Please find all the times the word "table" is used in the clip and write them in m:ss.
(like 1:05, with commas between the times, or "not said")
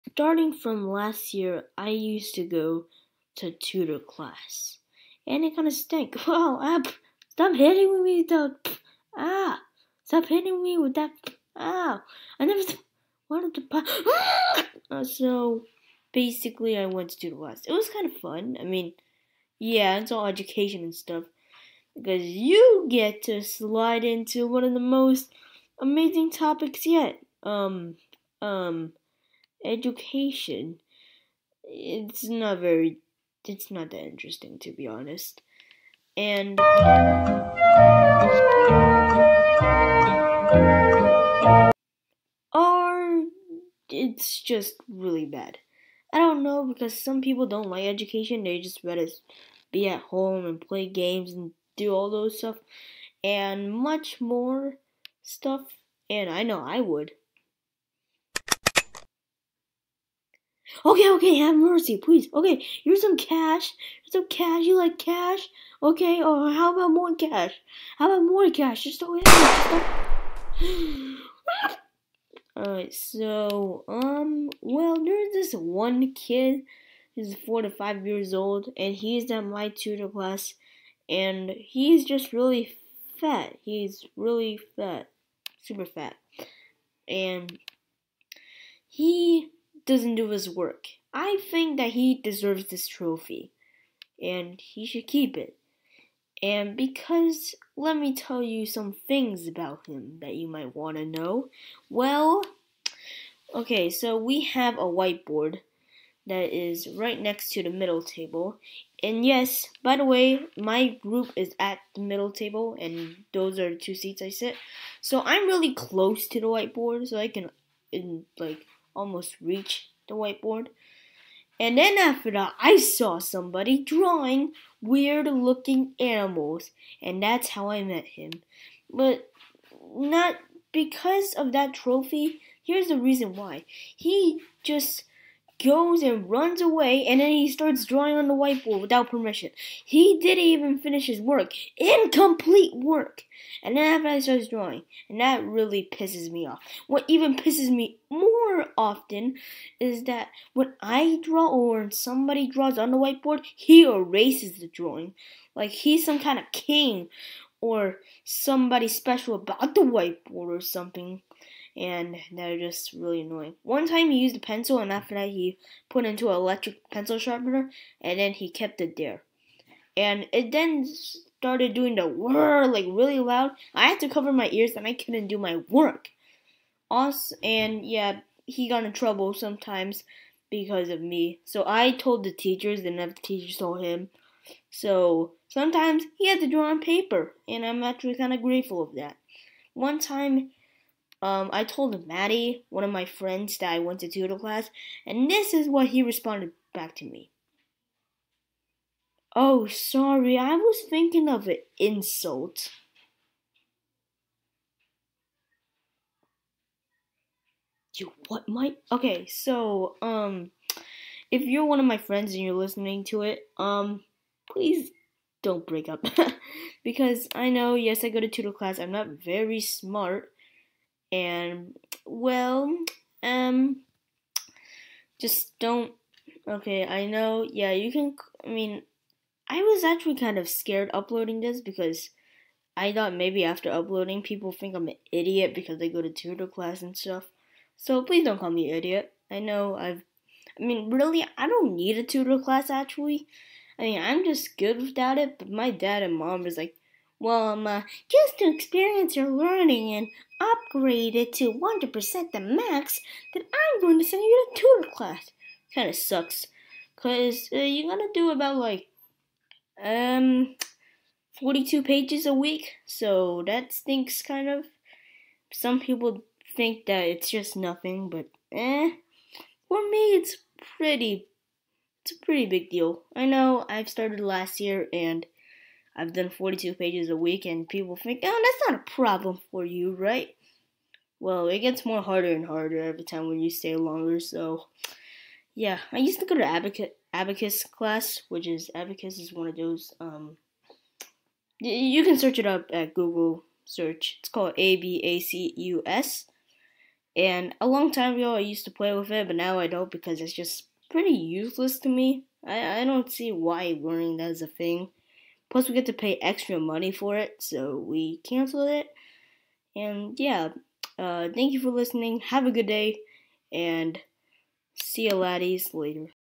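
1:48, 1:52.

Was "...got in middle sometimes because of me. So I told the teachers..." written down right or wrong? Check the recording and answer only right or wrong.
wrong.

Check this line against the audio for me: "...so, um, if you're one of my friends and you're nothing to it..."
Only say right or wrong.
wrong.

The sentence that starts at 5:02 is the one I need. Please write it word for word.
I, I don't see why learning that is a thing.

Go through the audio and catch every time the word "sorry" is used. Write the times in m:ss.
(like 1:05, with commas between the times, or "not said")
3:19.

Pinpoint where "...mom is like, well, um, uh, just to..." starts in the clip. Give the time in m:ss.
4:06.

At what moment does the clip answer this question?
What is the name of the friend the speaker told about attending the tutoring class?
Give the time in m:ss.
3:12.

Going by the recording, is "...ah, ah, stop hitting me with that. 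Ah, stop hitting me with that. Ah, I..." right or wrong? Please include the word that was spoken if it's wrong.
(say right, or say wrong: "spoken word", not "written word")
right.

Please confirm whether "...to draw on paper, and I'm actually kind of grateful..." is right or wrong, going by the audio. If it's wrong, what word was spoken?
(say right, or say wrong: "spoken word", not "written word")
right.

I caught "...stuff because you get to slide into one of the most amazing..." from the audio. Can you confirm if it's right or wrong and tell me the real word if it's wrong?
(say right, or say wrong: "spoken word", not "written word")
right.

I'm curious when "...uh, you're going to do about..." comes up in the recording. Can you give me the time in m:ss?
4:17.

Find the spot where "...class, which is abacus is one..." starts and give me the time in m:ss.
4:47.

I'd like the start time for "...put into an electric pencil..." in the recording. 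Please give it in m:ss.
2:45.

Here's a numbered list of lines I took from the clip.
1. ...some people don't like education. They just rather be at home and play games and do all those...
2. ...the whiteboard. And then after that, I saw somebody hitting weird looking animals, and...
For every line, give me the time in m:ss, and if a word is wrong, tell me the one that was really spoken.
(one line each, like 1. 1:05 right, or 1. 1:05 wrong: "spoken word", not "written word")
1. 0:47 right
2. 2:00 wrong: "drawing", not "hitting".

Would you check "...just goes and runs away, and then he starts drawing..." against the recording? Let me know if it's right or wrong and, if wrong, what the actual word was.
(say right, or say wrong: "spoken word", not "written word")
right.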